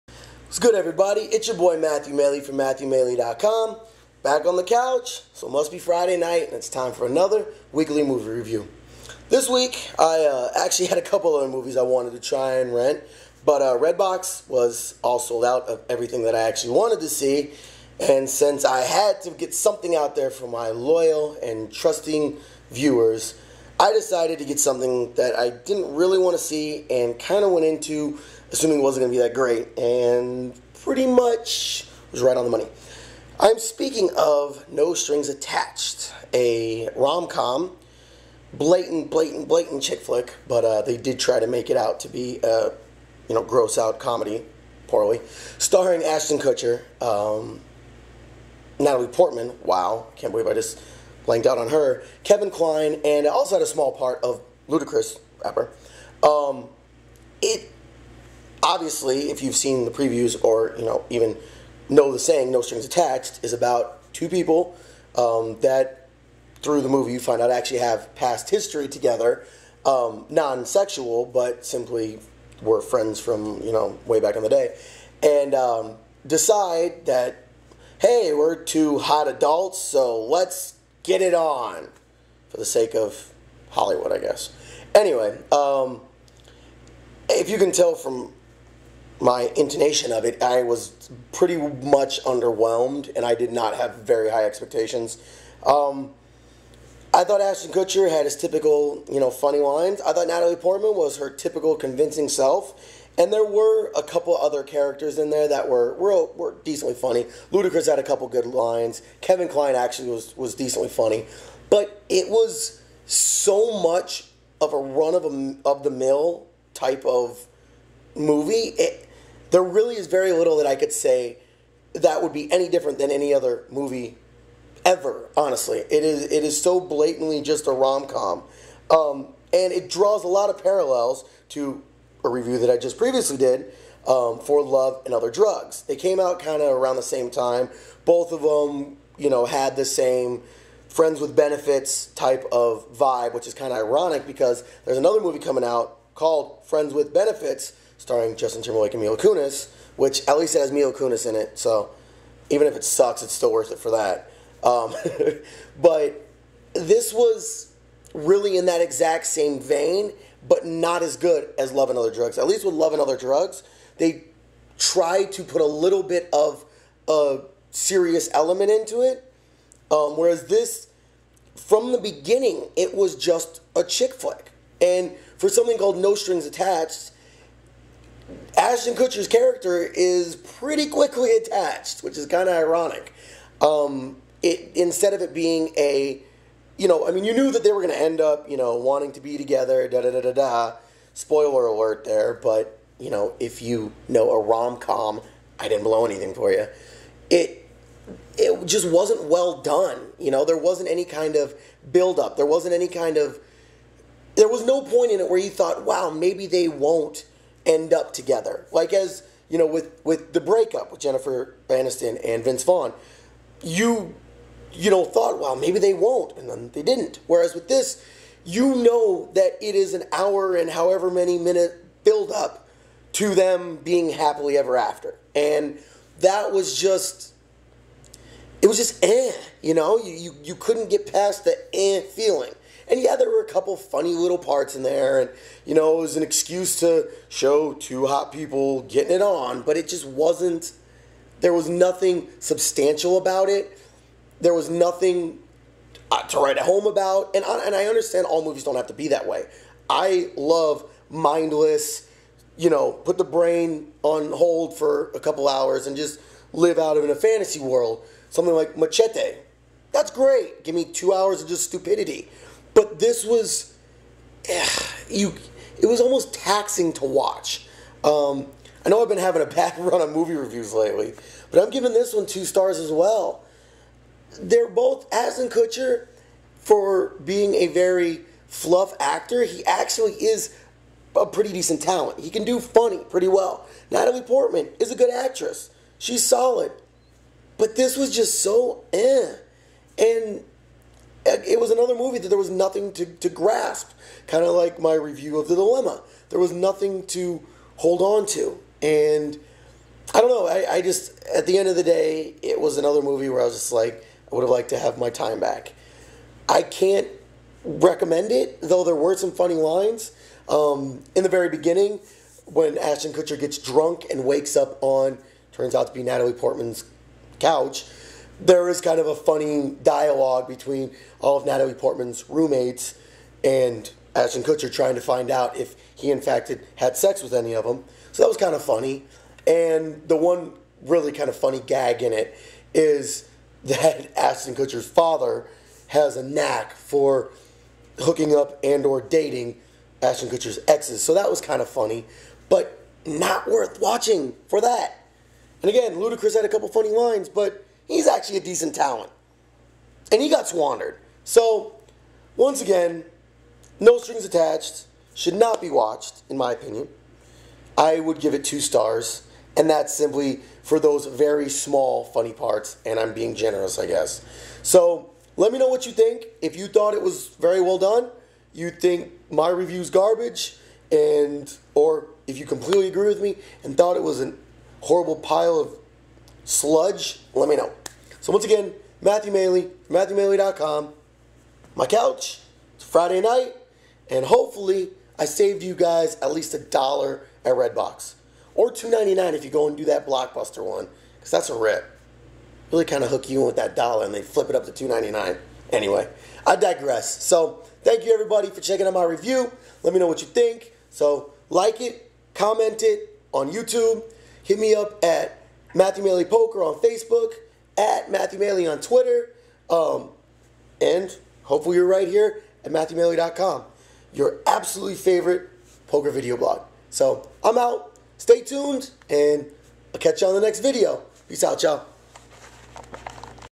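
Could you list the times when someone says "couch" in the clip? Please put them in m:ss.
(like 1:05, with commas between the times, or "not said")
0:04, 5:17, 6:21.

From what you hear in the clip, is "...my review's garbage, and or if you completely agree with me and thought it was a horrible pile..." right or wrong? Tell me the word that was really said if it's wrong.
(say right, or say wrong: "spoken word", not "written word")
right.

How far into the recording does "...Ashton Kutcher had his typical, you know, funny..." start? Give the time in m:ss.
1:37.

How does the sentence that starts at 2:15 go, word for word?
They came out kind of around the same time.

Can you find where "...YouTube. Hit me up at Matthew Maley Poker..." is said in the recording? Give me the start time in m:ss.
6:43.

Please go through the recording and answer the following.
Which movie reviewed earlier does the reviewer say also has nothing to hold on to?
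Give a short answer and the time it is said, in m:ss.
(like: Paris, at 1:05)
The Dilemma, at 4:55.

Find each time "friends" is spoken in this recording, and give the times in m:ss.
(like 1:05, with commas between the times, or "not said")
1:12, 2:20, 2:26.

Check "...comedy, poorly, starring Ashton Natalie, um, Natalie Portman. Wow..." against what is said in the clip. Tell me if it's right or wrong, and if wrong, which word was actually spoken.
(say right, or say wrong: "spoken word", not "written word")
wrong: "Kutcher", not "Natalie".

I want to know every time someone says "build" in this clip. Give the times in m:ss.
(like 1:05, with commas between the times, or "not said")
3:21, 3:42.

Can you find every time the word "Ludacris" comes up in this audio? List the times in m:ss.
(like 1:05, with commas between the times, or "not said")
0:54, 1:47, 5:45.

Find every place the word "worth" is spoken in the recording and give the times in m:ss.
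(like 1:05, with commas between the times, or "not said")
2:33, 5:43.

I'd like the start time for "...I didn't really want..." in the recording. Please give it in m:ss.
0:25.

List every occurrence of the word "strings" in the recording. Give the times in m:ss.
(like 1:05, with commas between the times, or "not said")
0:34, 1:02, 2:56, 5:53.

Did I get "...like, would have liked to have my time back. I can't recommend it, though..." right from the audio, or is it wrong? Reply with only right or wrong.
right.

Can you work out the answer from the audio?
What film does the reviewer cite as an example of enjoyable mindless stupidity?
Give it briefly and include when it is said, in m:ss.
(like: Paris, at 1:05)
Machete, at 4:18.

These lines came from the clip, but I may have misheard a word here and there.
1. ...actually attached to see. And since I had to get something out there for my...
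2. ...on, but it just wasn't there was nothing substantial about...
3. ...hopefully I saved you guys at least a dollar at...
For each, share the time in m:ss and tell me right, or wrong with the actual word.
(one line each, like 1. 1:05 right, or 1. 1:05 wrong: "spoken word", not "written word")
1. 0:16 wrong: "wanted", not "attached"
2. 3:59 right
3. 6:24 right.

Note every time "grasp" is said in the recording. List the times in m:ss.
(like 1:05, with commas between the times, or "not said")
4:53.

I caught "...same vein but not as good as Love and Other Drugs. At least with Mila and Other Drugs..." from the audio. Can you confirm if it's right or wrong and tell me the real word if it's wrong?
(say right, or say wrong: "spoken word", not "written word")
wrong: "Love", not "Mila".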